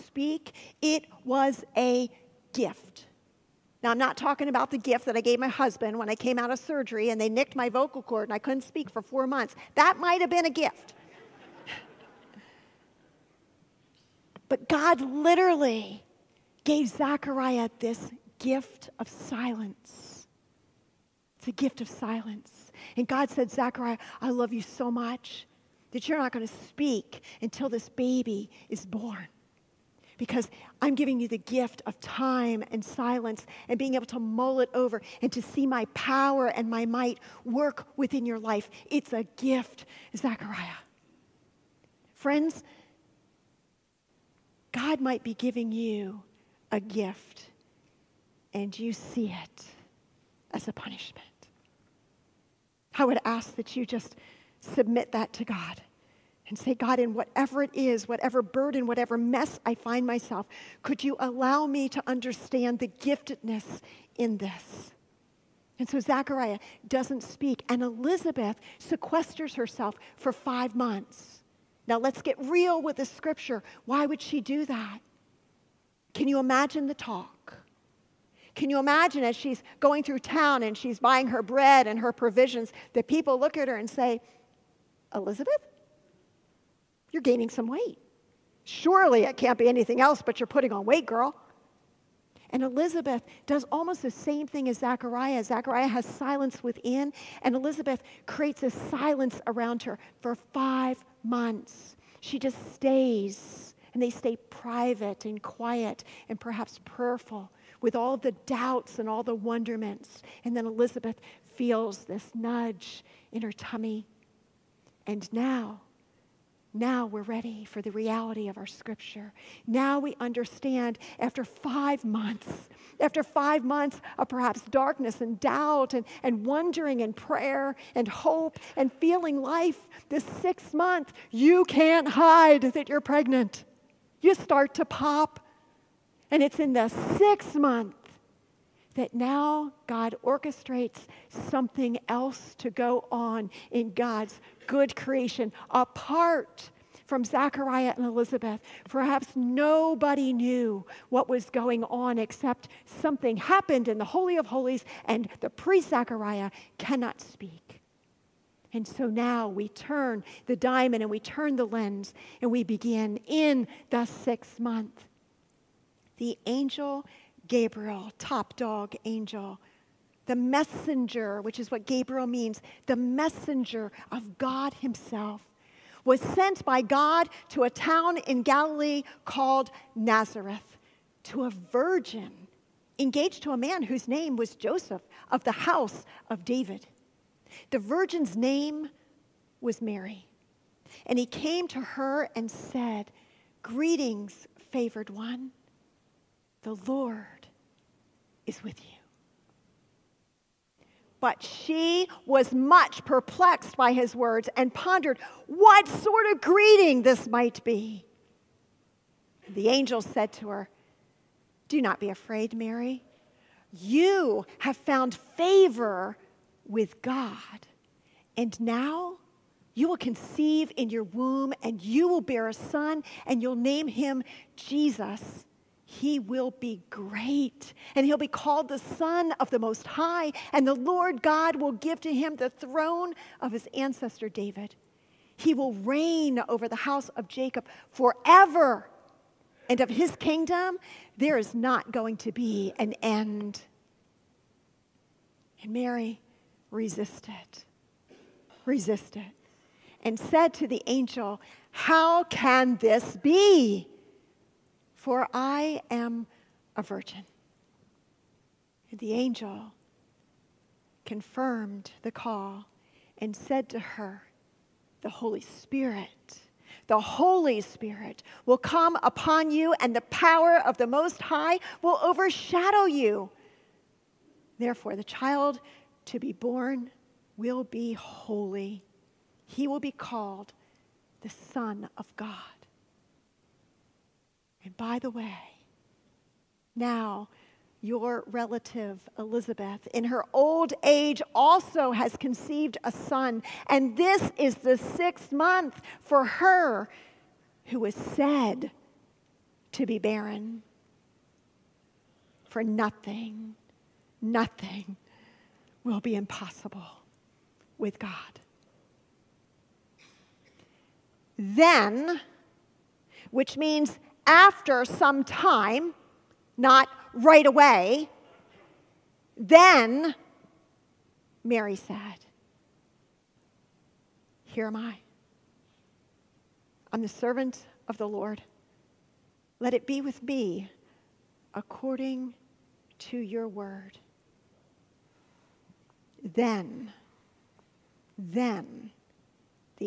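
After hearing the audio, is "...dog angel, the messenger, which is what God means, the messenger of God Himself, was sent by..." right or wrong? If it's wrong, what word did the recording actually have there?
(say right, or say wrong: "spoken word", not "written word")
wrong: "Gabriel", not "God".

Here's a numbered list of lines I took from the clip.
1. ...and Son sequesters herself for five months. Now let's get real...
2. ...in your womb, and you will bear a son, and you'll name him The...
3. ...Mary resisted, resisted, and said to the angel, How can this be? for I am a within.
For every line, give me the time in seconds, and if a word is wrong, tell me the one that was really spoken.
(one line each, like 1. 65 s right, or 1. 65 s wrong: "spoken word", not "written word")
1. 67 s wrong: "Elizabeth", not "Son"
2. 220 s wrong: "Jesus", not "The"
3. 245 s wrong: "virgin", not "within".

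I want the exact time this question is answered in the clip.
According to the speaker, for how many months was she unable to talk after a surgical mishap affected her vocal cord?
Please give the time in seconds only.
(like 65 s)
9 s.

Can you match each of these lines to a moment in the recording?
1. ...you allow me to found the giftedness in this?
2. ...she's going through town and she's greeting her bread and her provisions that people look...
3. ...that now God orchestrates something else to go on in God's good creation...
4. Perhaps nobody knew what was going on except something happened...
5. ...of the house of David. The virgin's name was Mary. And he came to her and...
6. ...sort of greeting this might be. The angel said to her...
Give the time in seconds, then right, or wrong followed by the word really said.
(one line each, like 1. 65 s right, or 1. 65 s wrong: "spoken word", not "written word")
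1. 61 s wrong: "understand", not "found"
2. 79 s wrong: "buying", not "greeting"
3. 138 s right
4. 148 s right
5. 185 s right
6. 205 s right.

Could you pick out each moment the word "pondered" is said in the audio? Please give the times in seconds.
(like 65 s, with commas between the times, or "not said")
204 s.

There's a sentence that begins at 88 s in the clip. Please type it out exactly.
Surely it can't be anything else, but you're putting on weight, girl.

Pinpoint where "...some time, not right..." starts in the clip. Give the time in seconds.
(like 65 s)
314 s.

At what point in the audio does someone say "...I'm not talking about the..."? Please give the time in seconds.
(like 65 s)
3 s.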